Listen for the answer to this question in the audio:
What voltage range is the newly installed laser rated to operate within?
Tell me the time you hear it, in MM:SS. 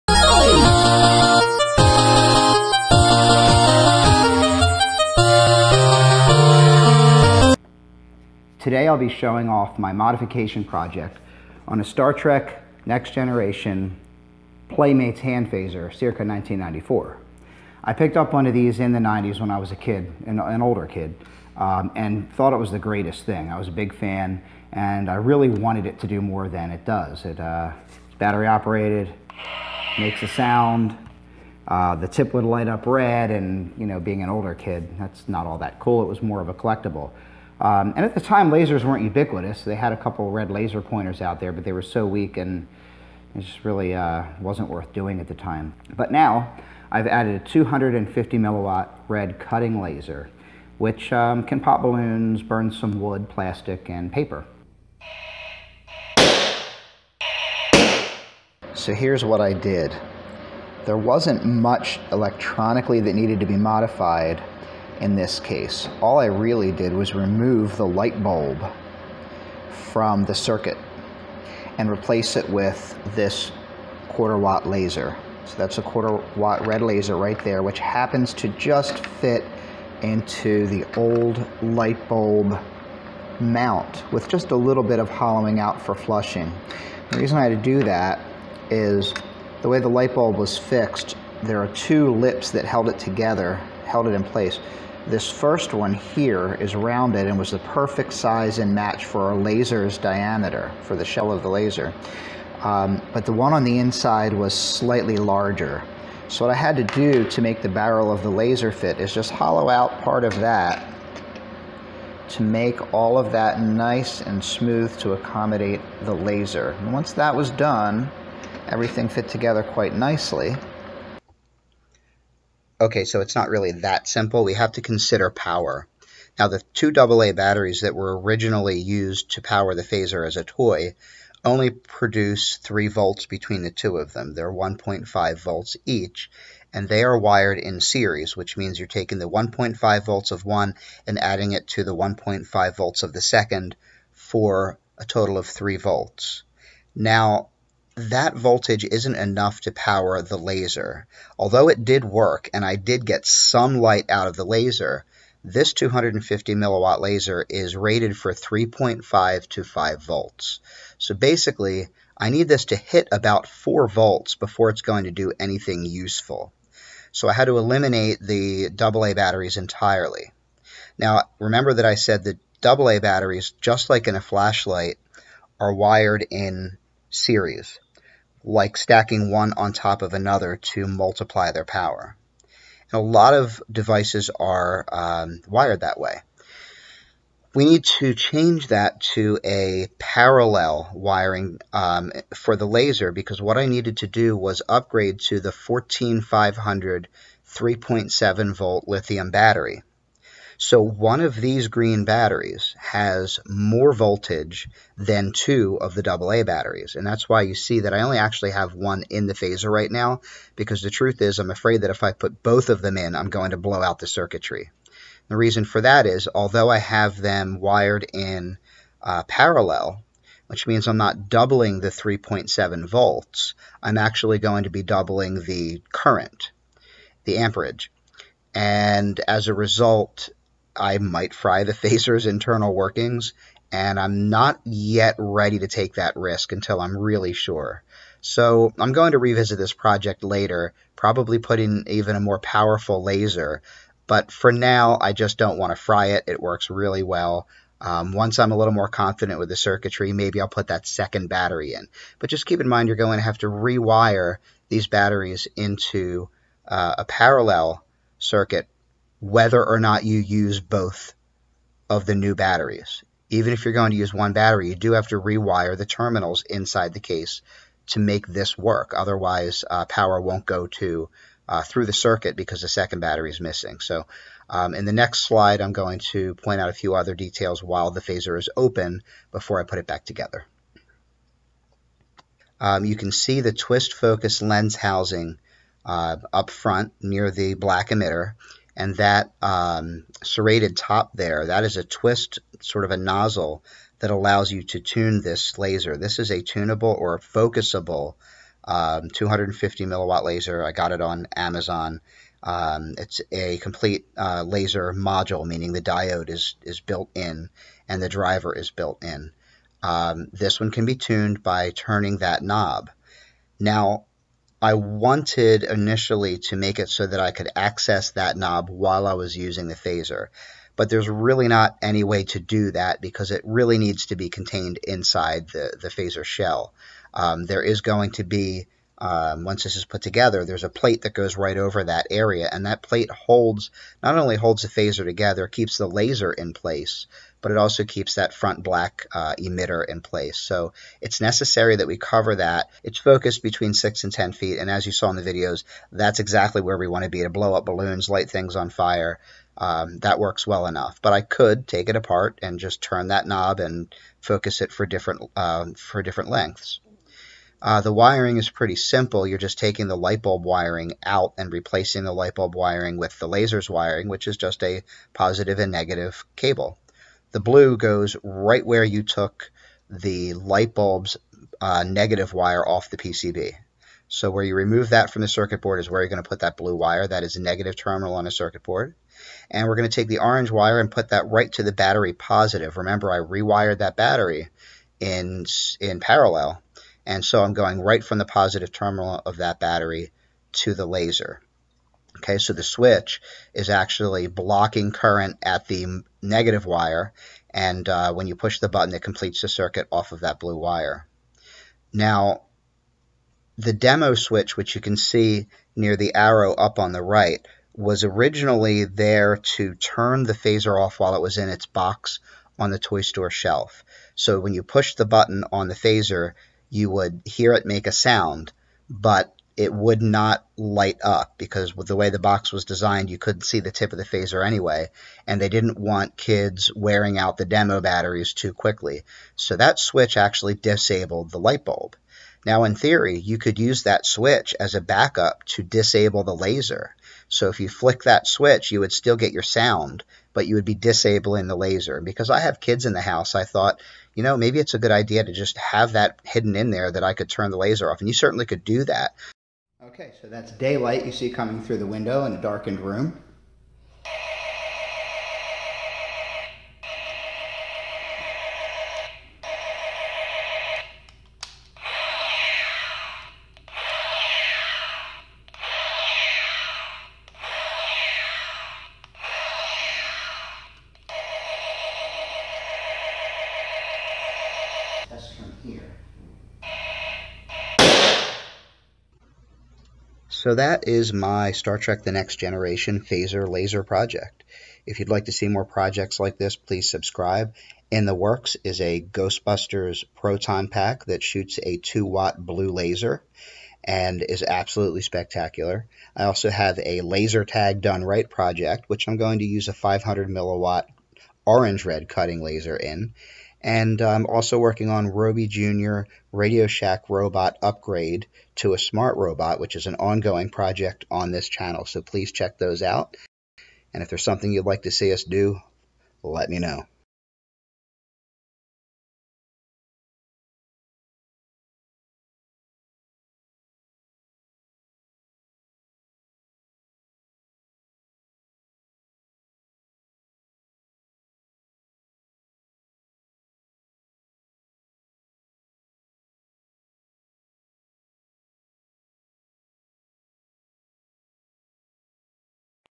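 02:38.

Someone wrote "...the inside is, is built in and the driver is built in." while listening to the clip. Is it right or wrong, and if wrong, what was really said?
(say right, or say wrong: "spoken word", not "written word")
wrong: "diode", not "inside".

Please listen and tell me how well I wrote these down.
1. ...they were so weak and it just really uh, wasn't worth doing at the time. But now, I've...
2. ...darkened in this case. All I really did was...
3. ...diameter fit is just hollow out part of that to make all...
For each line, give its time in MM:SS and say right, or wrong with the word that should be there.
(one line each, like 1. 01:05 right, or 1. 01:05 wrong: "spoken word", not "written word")
1. 00:41 right
2. 01:03 wrong: "modified", not "darkened"
3. 01:48 wrong: "laser", not "diameter".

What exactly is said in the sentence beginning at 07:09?
So that switch actually disabled the light bulb.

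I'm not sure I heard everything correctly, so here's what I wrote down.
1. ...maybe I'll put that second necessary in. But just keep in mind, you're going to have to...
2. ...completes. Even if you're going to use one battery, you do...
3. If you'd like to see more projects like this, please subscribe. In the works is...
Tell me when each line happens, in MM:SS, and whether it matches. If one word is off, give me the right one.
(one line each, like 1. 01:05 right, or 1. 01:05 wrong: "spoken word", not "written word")
1. 04:10 wrong: "battery", not "necessary"
2. 04:22 wrong: "batteries", not "completes"
3. 08:04 right.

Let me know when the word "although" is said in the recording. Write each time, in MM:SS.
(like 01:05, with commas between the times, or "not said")
02:31, 03:36.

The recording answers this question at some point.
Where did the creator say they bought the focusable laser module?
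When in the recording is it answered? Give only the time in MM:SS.
05:01.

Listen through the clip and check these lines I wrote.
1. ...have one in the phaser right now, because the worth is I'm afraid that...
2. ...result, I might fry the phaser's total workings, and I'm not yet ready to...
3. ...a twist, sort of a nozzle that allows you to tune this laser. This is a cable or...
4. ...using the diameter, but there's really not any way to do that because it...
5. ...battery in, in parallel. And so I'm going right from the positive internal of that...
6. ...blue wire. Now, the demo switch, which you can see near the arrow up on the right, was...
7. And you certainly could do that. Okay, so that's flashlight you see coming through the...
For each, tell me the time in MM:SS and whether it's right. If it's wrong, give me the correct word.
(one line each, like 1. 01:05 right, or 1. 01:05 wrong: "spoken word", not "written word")
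1. 03:28 wrong: "truth", not "worth"
2. 03:49 wrong: "internal", not "total"
3. 04:51 wrong: "tunable", not "cable"
4. 05:19 wrong: "phaser", not "diameter"
5. 06:23 wrong: "terminal", not "internal"
6. 06:40 right
7. 07:27 wrong: "daylight", not "flashlight".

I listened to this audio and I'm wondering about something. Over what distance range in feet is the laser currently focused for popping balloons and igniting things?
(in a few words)
6 and 10 feet.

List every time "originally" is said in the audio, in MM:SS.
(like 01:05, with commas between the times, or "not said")
02:08, 06:48.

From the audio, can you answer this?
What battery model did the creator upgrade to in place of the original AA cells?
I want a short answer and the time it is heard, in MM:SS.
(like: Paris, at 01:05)
14500, at 03:15.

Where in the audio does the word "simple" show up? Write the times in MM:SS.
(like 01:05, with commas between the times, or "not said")
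02:04, 05:58.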